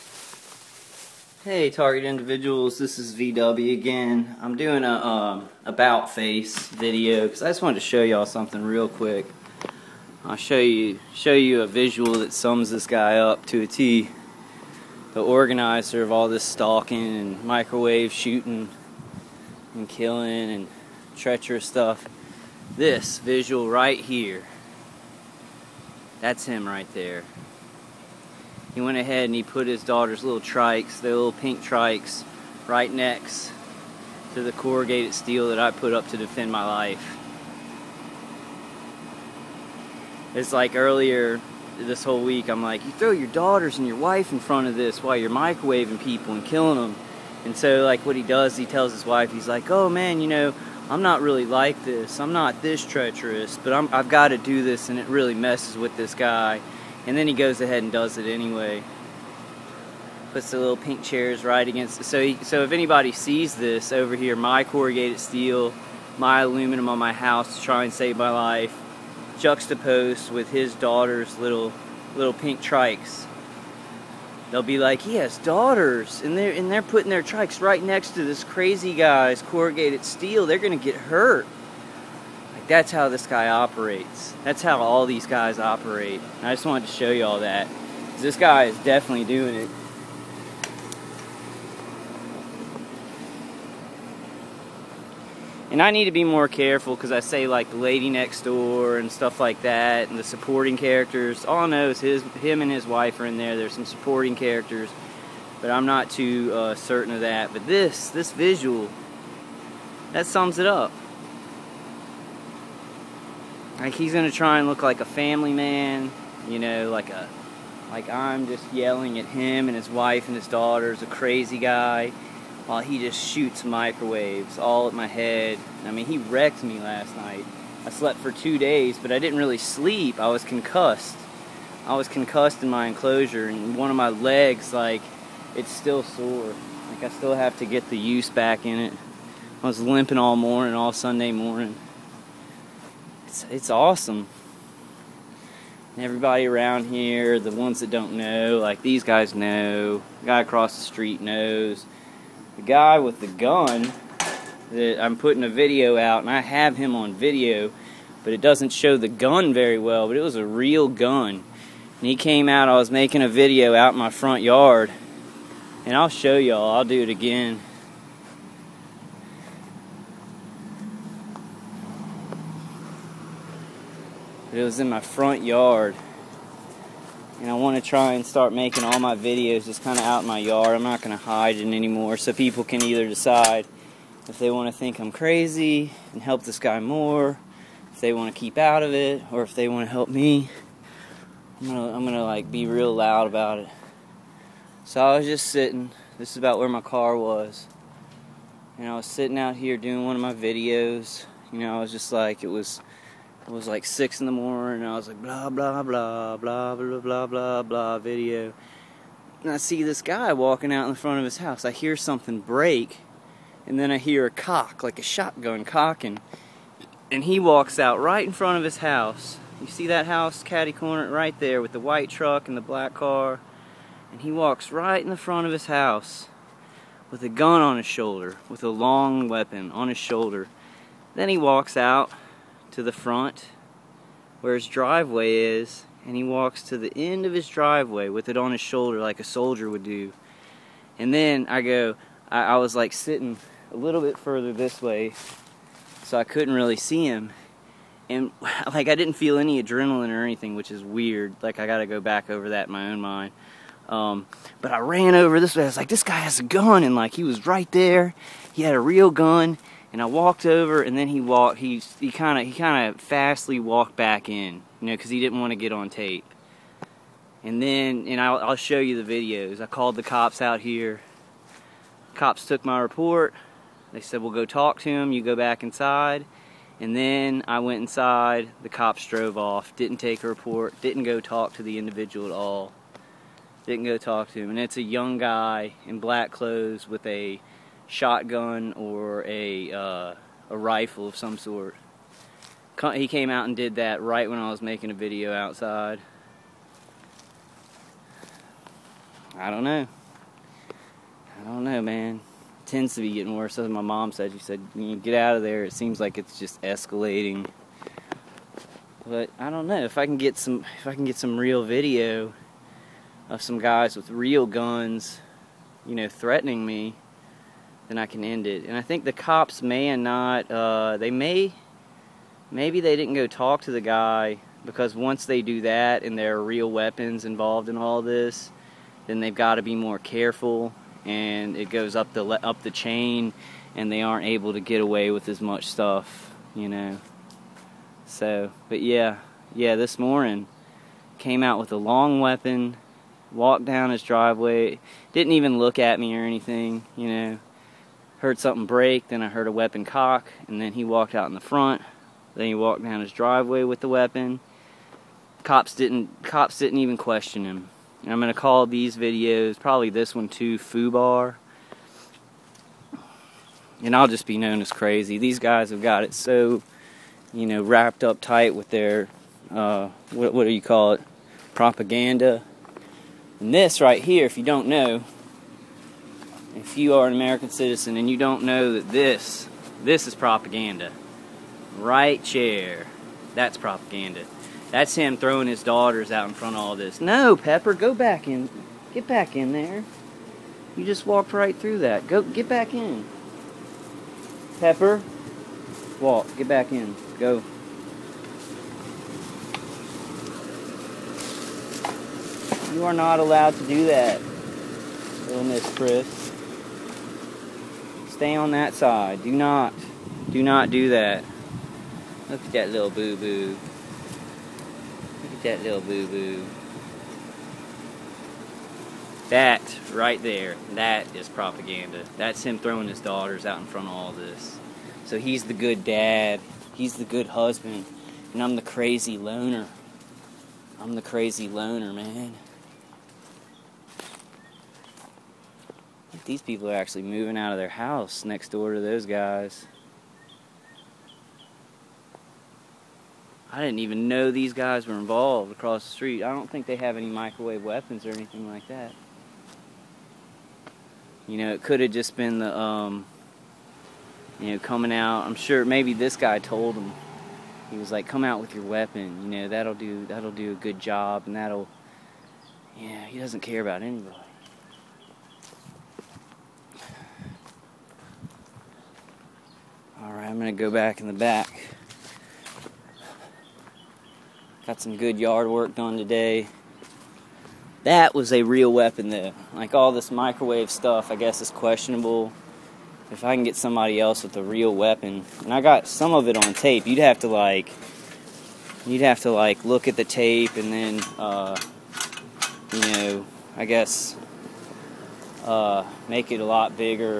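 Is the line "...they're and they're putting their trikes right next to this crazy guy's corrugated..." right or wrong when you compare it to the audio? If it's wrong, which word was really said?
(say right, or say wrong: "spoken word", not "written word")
right.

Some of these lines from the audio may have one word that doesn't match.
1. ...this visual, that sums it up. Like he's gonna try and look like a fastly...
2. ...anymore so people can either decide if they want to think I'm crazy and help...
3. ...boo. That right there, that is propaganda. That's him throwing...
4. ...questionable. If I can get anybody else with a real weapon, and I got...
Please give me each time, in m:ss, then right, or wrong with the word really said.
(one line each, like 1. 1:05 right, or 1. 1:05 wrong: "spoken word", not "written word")
1. 1:48 wrong: "family", not "fastly"
2. 3:01 right
3. 6:56 right
4. 8:01 wrong: "somebody", not "anybody".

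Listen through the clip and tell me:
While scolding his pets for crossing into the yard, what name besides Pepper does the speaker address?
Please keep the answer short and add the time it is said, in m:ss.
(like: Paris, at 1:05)
Little Miss Chris, at 6:45.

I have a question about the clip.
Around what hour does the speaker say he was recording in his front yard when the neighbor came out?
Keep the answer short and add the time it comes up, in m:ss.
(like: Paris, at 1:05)
6 in the morning, at 3:23.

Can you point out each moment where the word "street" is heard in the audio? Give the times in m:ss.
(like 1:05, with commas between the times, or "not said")
2:30, 7:25.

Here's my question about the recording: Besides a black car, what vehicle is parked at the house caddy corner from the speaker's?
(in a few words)
White truck.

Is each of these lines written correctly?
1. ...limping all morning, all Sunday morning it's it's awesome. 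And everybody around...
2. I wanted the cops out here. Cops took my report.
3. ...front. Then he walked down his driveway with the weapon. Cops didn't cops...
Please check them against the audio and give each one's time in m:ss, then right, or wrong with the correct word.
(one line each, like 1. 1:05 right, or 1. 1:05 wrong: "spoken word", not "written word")
1. 2:19 right
2. 4:29 wrong: "called", not "wanted"
3. 5:51 right.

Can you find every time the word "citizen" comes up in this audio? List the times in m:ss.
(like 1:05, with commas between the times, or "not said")
6:17.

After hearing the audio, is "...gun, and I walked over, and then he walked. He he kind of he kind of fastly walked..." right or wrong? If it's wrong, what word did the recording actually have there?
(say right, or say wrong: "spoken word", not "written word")
right.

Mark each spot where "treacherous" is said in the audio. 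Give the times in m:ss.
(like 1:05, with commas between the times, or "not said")
0:21, 0:52.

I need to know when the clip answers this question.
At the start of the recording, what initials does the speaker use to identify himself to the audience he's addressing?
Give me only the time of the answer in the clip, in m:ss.
0:03.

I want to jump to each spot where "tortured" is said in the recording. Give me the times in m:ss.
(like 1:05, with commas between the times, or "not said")
not said.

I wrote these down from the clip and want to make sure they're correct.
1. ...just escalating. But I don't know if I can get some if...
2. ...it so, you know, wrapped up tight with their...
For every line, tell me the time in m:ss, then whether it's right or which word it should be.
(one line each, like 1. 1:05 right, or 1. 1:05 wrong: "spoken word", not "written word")
1. 5:06 right
2. 6:06 right.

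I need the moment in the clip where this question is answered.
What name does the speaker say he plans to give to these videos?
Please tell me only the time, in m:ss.
6:00.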